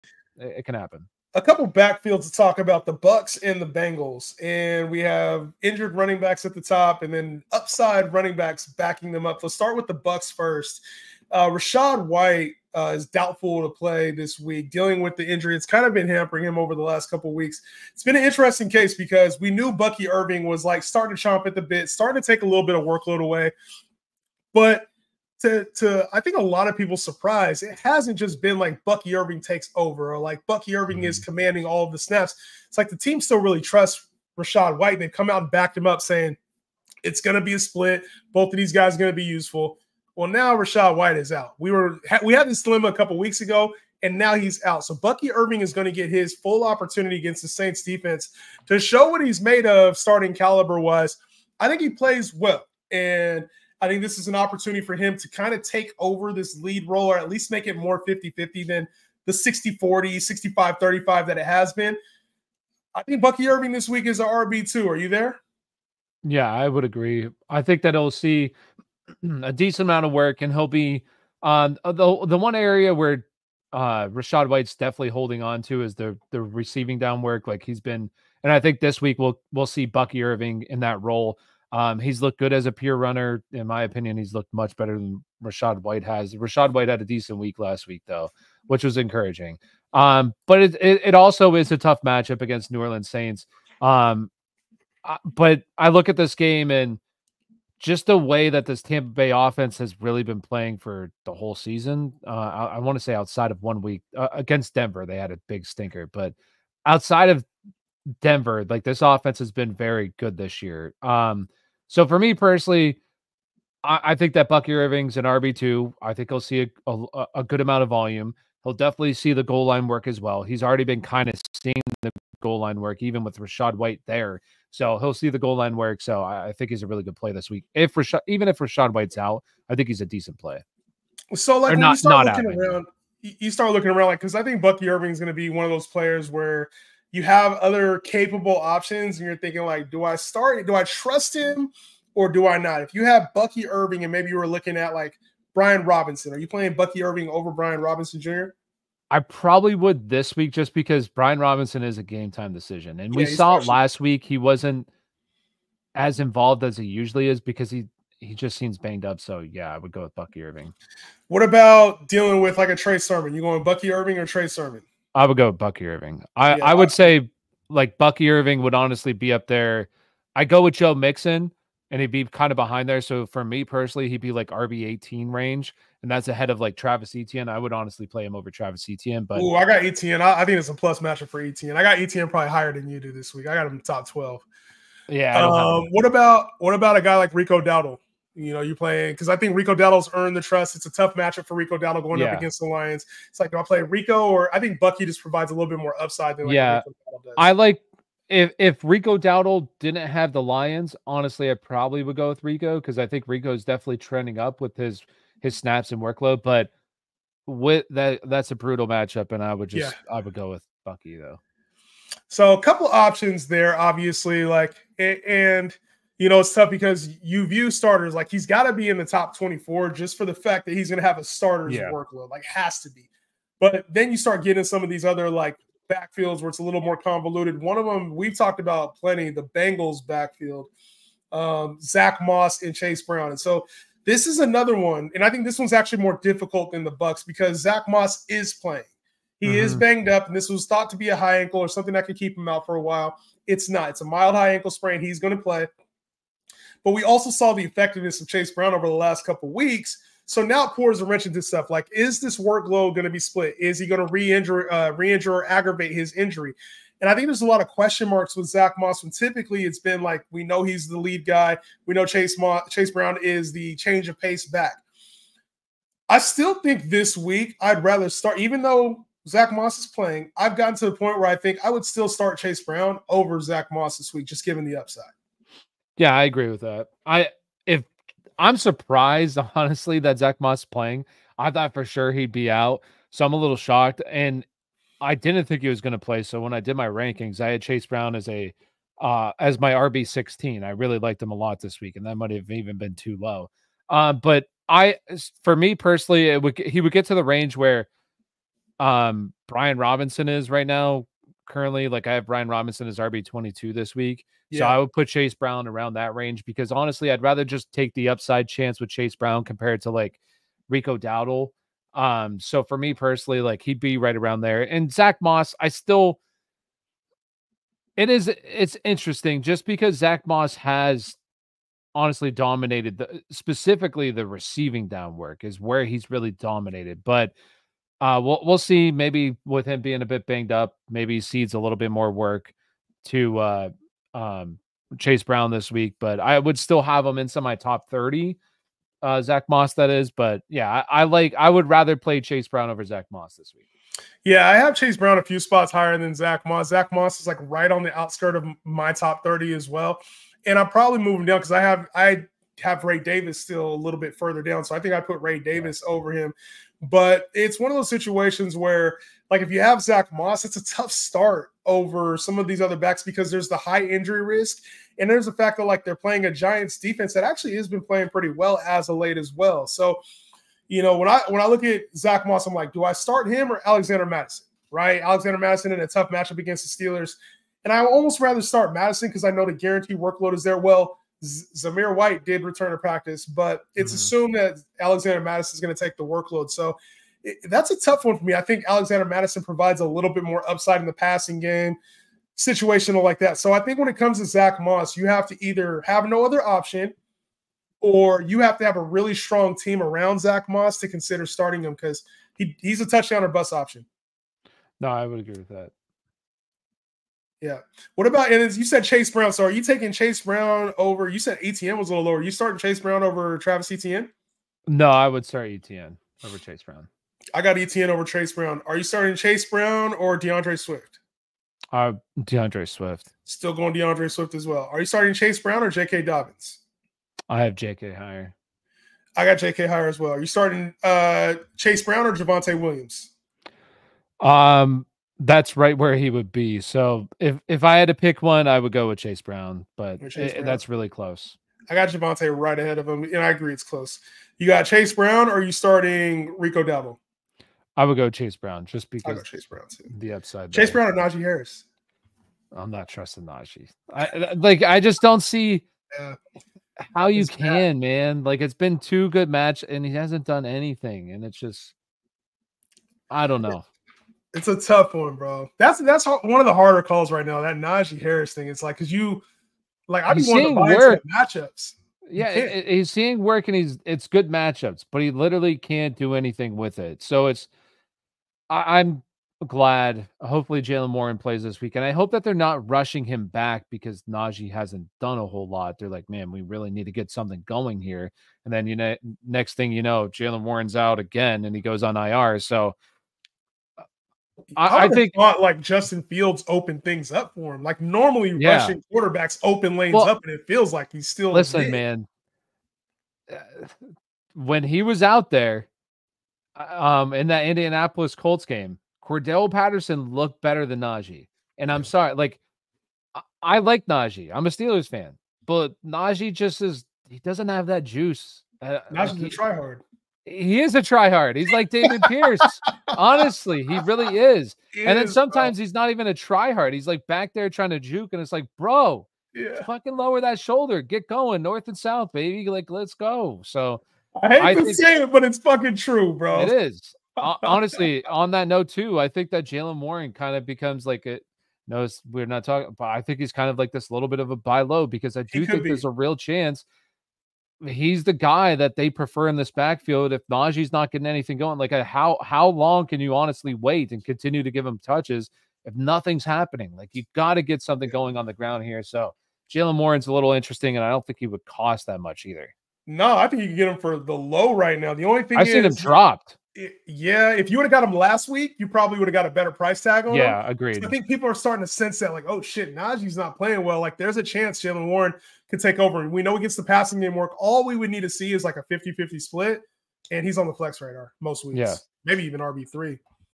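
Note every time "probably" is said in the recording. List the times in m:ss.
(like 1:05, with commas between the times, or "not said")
2:29, 3:02, 3:21, 5:50, 9:28.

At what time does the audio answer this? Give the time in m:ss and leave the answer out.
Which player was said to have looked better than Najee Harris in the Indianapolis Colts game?
8:29.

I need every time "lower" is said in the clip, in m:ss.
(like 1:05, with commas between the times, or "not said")
6:52, 8:49.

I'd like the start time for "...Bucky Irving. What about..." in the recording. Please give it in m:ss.
2:40.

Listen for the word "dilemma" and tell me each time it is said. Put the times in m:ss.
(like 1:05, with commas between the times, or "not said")
0:42.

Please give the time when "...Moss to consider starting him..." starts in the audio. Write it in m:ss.
6:40.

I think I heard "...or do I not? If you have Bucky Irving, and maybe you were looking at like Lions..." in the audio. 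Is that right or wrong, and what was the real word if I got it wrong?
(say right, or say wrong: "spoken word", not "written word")
wrong: "Brian", not "Lions".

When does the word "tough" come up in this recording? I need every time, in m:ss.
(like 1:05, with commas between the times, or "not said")
1:31, 3:10, 3:36, 6:00, 6:15, 6:27, 7:44.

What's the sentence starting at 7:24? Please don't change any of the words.
You got Chase Brown, or are you starting Rico Dowdle?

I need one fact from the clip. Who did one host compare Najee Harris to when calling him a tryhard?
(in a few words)
David Pierce.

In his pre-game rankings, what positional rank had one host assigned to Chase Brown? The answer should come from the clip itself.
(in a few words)
RB 16.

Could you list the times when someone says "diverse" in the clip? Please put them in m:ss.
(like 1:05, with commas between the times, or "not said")
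not said.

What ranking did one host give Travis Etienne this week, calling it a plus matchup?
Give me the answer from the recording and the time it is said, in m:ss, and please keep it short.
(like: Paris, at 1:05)
Top 12, at 3:03.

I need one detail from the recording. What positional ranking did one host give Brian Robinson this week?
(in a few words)
RB 22.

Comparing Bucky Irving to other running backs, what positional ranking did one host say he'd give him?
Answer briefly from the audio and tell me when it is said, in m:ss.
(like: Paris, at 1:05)
RB 18, at 2:54.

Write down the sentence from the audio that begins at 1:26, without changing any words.
Rachaad White had a decent week last week, though, which was encouraging.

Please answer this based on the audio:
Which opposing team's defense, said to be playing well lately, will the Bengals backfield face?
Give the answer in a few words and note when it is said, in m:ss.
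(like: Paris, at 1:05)
Giants, at 6:06.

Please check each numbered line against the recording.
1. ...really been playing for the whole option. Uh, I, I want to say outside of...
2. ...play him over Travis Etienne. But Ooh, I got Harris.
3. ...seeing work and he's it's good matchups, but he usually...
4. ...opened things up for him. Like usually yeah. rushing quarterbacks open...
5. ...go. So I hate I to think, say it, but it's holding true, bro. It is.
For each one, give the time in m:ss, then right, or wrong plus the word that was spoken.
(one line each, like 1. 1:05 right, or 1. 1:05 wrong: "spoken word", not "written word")
1. 1:40 wrong: "season", not "option"
2. 2:58 wrong: "Etienne", not "Harris"
3. 7:52 wrong: "literally", not "usually"
4. 8:16 wrong: "normally", not "usually"
5. 8:52 wrong: "fucking", not "holding".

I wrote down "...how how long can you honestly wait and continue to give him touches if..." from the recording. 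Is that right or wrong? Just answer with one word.
right.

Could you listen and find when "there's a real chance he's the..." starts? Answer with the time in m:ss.
9:05.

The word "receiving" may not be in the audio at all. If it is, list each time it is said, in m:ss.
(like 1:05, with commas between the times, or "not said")
1:16, 5:24.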